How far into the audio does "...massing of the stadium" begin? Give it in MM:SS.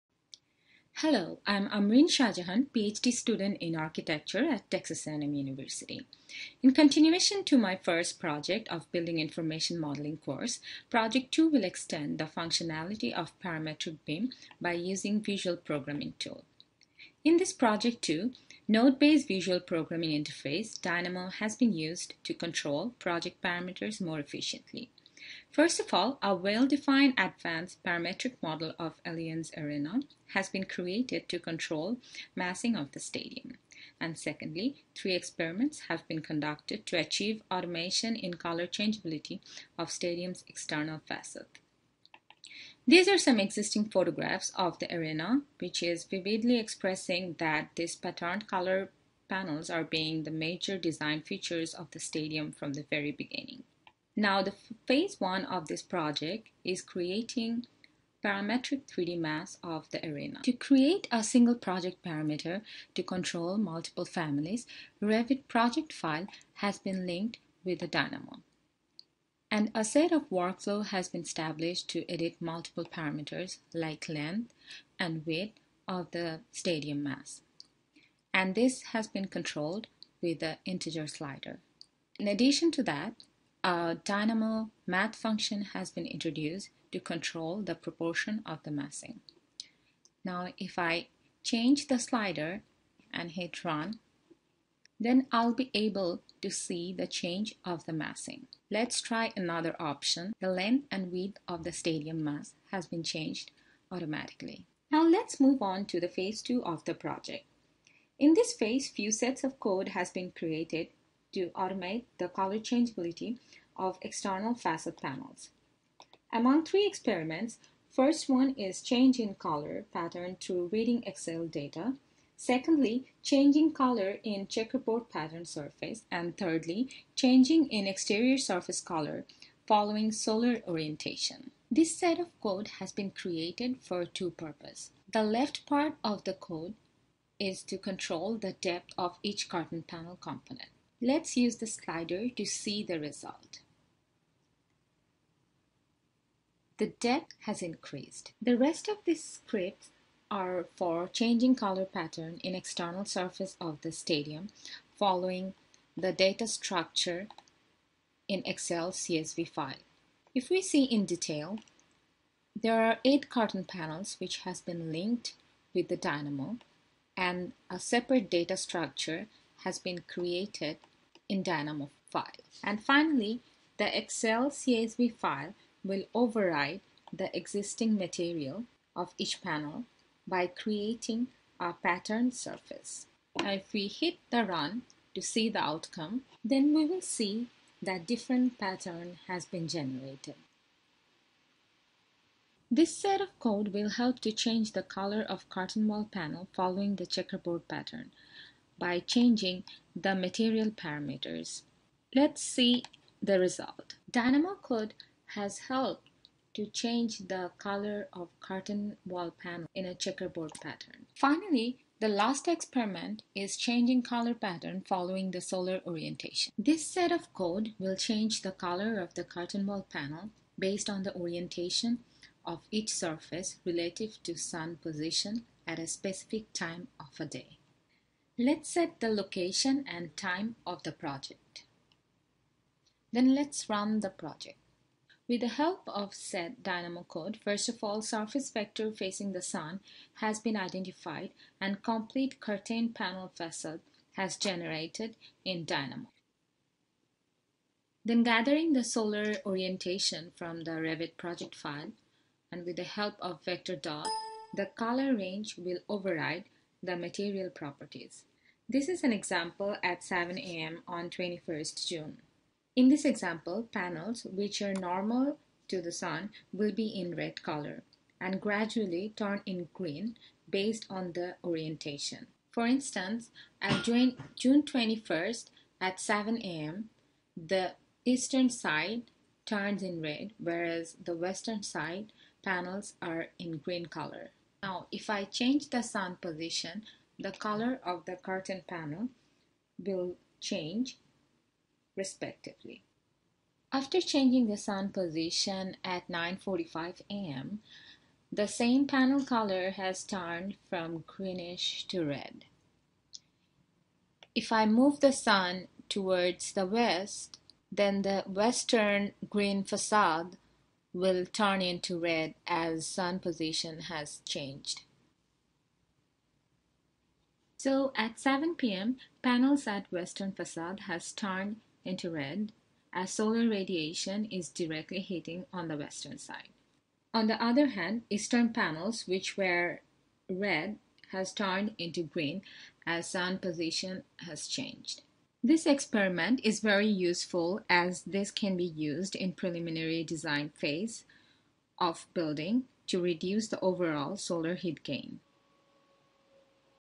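00:32.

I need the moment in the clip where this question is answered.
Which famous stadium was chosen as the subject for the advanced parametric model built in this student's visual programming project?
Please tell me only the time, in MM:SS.
00:29.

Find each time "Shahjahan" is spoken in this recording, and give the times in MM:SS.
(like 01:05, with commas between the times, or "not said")
00:02.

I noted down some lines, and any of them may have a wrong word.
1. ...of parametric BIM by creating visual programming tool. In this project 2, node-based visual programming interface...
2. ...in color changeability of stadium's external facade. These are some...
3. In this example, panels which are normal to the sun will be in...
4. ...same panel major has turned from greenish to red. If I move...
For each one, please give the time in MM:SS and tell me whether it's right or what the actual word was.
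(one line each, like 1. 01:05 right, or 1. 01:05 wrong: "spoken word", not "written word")
1. 00:13 wrong: "using", not "creating"
2. 00:38 right
3. 04:22 right
4. 04:58 wrong: "color", not "major".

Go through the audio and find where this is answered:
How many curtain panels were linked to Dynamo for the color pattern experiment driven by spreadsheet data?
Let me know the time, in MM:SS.
02:43.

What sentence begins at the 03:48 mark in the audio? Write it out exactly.
Let's set the location and time of the project.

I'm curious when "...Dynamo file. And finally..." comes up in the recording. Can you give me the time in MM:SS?
02:51.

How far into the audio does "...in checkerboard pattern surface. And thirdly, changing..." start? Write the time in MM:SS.
02:04.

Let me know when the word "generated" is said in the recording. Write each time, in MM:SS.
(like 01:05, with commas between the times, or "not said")
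03:09, 04:04.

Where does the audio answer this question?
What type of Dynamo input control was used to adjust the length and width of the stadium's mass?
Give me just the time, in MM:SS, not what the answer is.
01:20.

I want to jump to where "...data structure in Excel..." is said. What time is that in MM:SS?
02:36.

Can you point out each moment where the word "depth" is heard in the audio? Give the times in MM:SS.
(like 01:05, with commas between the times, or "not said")
02:18, 02:27.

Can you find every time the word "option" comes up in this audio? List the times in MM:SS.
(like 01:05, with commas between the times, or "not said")
01:39.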